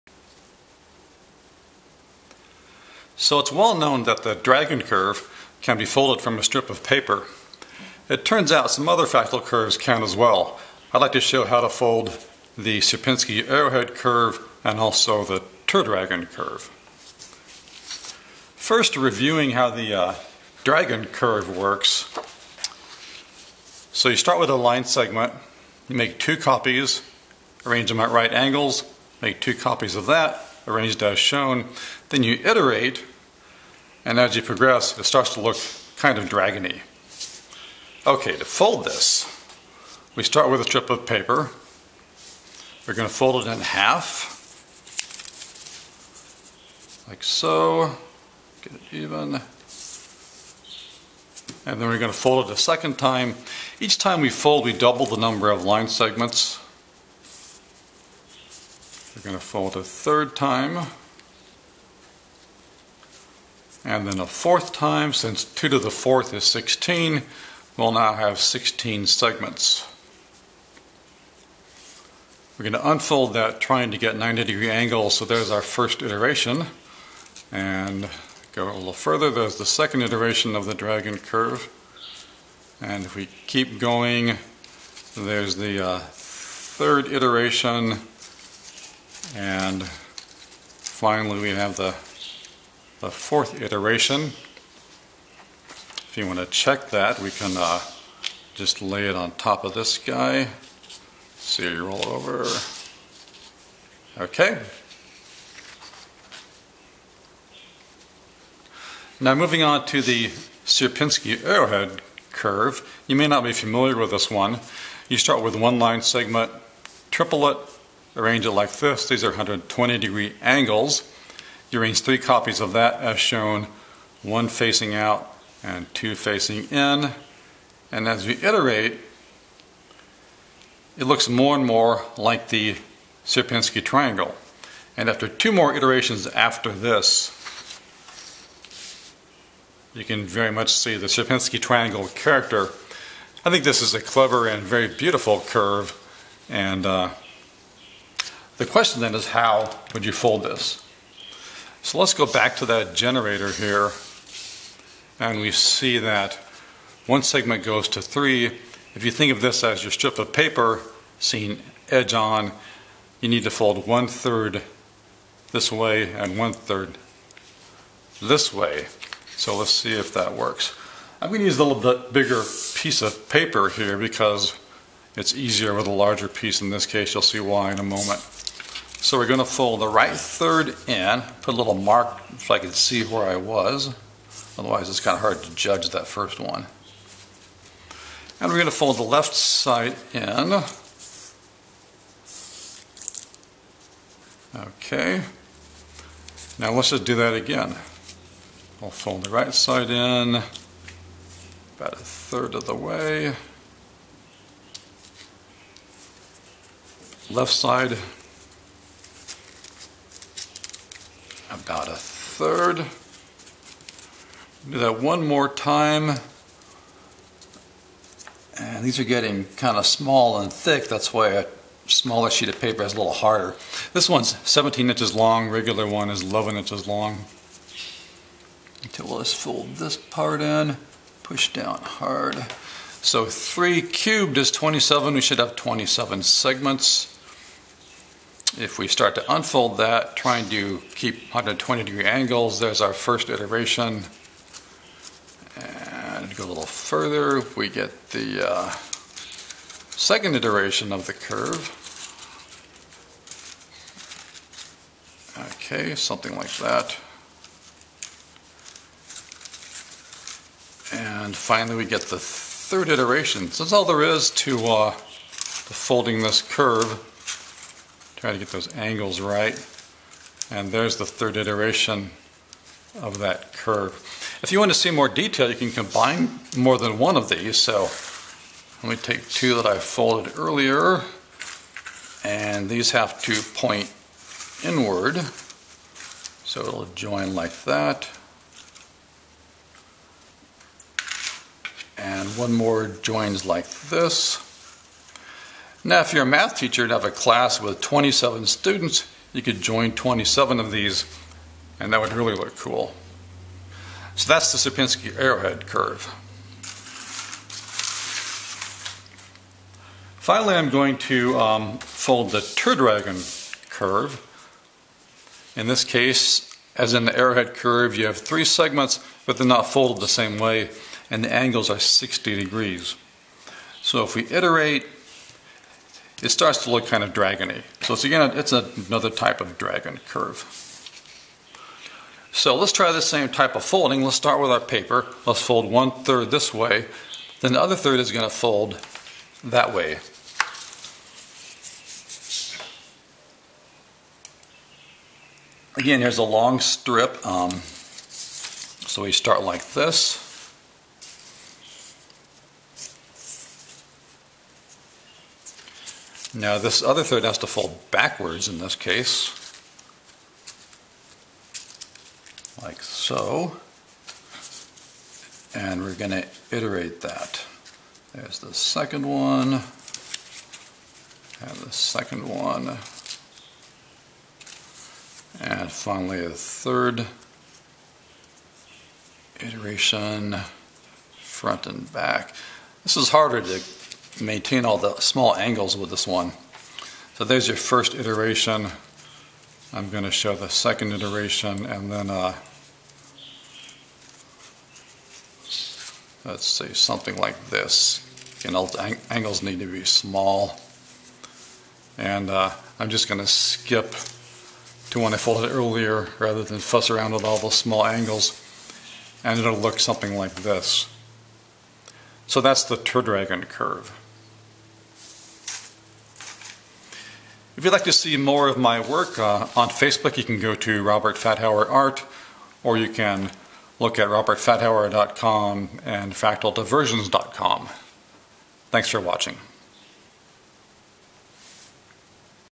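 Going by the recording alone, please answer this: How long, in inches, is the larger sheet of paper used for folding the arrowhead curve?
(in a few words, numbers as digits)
17 inches.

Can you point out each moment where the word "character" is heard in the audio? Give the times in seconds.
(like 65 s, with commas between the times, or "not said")
142 s.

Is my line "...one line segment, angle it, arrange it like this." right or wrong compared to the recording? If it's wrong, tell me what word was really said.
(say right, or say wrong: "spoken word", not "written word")
wrong: "triple", not "angle".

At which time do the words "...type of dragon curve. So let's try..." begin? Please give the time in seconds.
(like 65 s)
329 s.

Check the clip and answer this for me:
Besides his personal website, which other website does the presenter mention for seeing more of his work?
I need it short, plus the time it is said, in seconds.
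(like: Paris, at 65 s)
fractaldiversions.com, at 426 s.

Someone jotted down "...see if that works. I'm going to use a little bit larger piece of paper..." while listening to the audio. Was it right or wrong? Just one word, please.
wrong.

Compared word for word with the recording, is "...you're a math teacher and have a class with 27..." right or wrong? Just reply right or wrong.
right.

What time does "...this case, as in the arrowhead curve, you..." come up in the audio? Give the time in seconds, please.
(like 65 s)
315 s.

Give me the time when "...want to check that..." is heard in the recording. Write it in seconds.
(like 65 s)
96 s.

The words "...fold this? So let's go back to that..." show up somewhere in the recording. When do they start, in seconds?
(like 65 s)
150 s.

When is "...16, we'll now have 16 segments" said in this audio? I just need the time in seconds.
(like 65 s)
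66 s.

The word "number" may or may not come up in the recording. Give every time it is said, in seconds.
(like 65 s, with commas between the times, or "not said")
55 s.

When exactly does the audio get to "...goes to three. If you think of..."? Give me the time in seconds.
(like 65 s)
157 s.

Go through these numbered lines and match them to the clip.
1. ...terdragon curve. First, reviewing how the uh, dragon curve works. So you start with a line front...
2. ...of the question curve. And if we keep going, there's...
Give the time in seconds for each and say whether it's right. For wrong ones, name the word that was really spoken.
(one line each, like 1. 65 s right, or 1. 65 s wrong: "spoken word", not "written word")
1. 15 s wrong: "segment", not "front"
2. 80 s wrong: "dragon", not "question".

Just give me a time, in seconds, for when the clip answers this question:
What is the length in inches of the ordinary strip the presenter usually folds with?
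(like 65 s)
226 s.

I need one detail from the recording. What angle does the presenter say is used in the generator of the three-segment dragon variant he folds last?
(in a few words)
60 degrees.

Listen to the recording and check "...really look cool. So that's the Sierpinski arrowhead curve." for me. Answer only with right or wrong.
right.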